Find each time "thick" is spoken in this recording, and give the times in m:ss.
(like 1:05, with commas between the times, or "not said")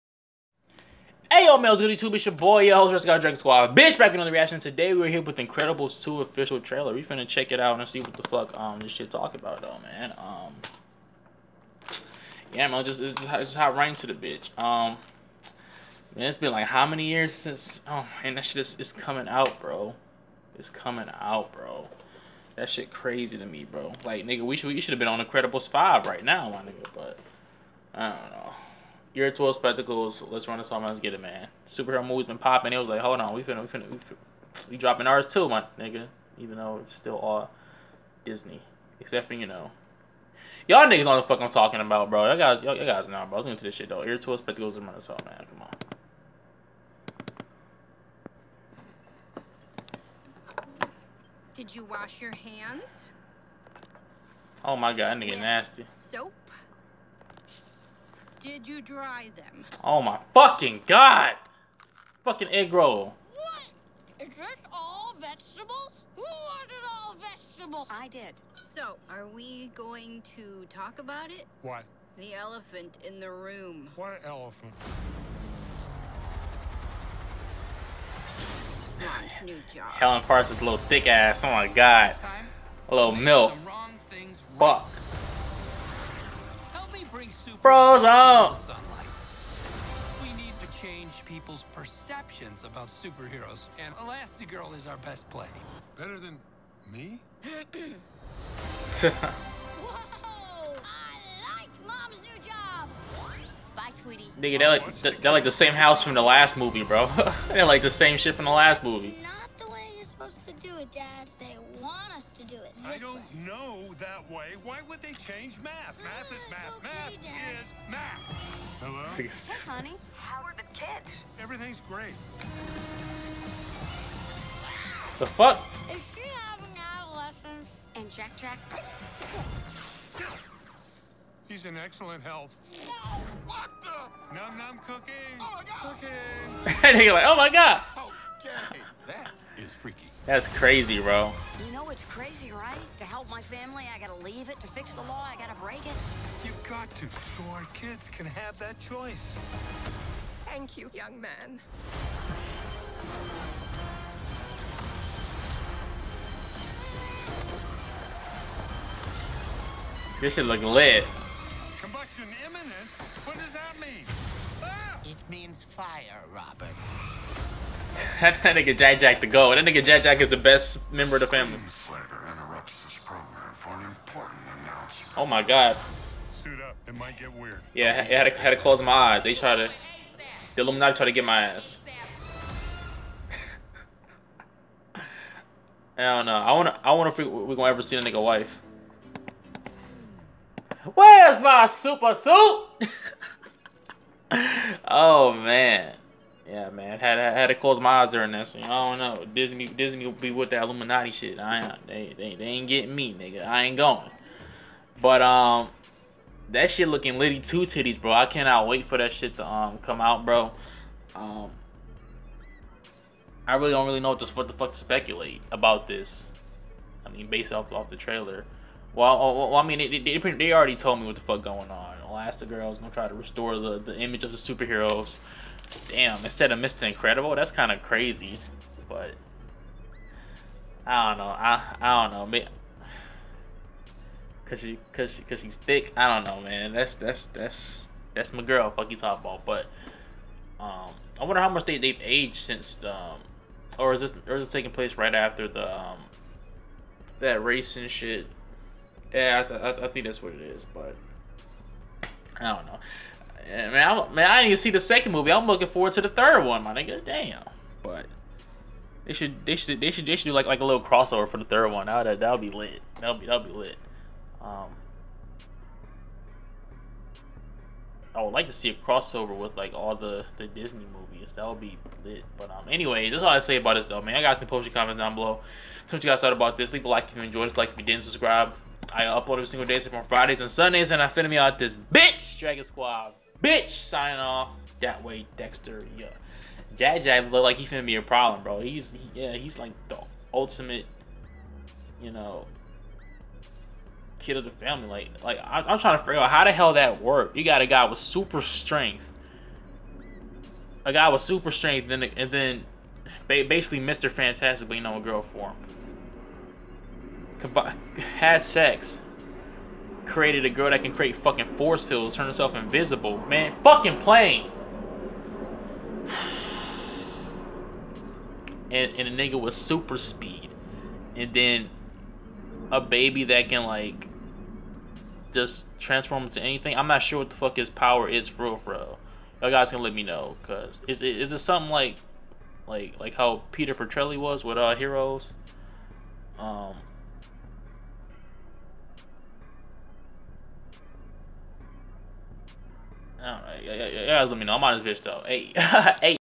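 1:20, 3:55.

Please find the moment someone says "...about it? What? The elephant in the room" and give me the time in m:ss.
1:10.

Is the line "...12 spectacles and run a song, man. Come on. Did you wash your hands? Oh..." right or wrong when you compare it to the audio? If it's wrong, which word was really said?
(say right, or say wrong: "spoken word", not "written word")
right.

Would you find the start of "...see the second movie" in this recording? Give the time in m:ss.
4:14.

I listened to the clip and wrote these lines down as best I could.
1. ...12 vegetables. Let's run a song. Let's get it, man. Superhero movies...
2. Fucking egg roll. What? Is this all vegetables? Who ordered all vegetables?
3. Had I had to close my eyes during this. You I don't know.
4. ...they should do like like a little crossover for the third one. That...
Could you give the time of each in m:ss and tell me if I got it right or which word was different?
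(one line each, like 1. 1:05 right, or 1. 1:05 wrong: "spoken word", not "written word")
1. 0:29 wrong: "spectacles", not "vegetables"
2. 1:02 right
3. 3:16 right
4. 4:20 right.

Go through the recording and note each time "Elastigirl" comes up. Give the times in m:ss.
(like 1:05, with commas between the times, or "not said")
1:33, 3:42.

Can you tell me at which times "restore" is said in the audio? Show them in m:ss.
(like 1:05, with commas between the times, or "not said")
3:43.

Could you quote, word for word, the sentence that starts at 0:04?
Today, we're here with Incredibles 2 official trailer.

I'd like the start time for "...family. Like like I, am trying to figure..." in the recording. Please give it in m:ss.
4:54.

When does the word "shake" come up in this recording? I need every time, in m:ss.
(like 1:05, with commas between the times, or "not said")
not said.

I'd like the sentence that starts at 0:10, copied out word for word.
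Um, yeah, man, just it's, it's hot right into the bitch.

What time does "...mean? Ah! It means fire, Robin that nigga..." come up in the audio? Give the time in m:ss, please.
2:43.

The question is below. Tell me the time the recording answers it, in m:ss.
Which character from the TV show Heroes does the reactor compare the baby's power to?
5:33.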